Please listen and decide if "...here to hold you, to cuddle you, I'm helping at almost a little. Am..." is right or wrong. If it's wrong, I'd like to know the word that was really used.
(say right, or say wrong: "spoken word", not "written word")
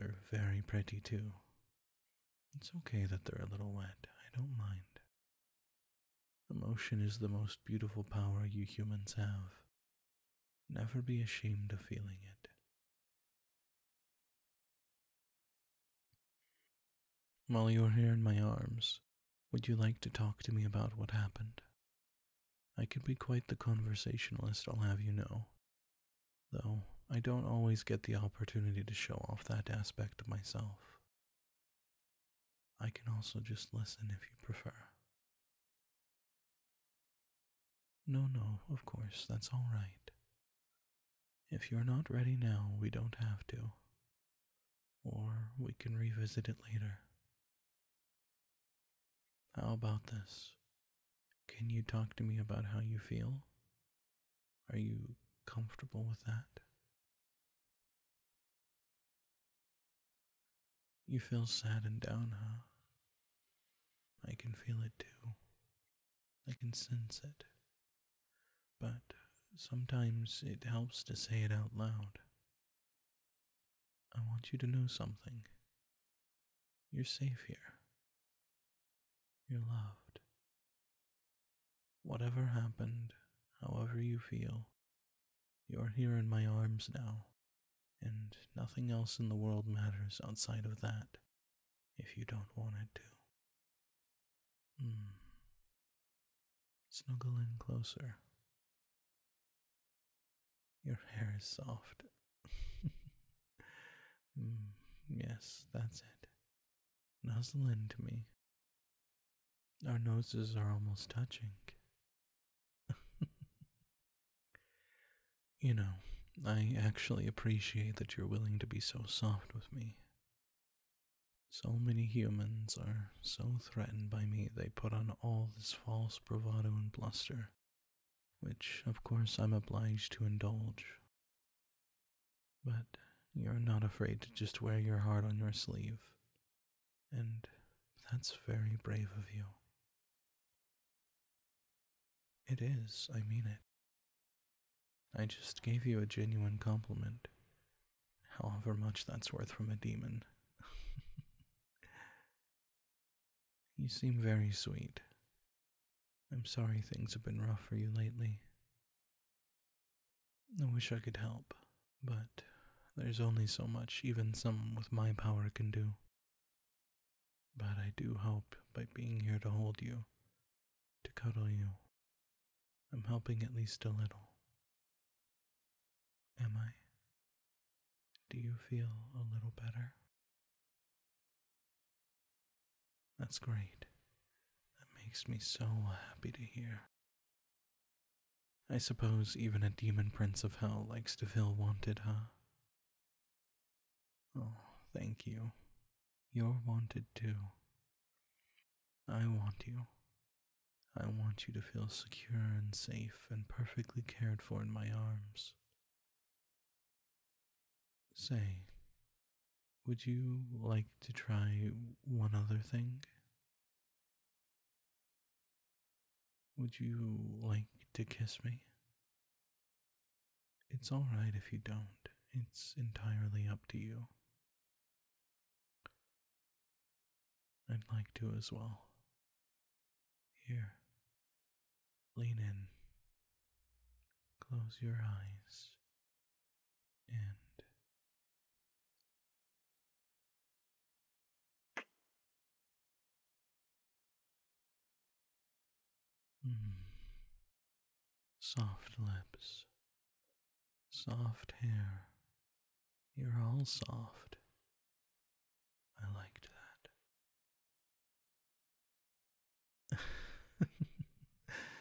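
wrong: "least", not "almost".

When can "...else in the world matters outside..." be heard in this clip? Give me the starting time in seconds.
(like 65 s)
88 s.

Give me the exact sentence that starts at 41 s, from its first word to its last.
If you're not ready now, we don't have to.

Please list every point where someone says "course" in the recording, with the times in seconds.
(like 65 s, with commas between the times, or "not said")
38 s, 129 s.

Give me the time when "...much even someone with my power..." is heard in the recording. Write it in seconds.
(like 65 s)
163 s.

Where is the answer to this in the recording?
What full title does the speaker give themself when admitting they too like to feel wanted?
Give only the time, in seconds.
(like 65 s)
189 s.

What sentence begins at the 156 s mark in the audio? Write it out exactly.
I'm sorry things have been rough for you lately.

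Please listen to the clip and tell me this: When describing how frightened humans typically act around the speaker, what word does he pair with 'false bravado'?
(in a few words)
bluster.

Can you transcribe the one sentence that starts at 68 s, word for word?
But sometimes it helps to say it out loud.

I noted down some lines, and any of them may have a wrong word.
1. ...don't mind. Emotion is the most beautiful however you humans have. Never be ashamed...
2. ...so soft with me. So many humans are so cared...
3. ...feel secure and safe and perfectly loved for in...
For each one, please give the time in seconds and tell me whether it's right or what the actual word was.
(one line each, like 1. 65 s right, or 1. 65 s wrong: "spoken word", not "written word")
1. 4 s wrong: "power", not "however"
2. 118 s wrong: "threatened", not "cared"
3. 201 s wrong: "cared", not "loved".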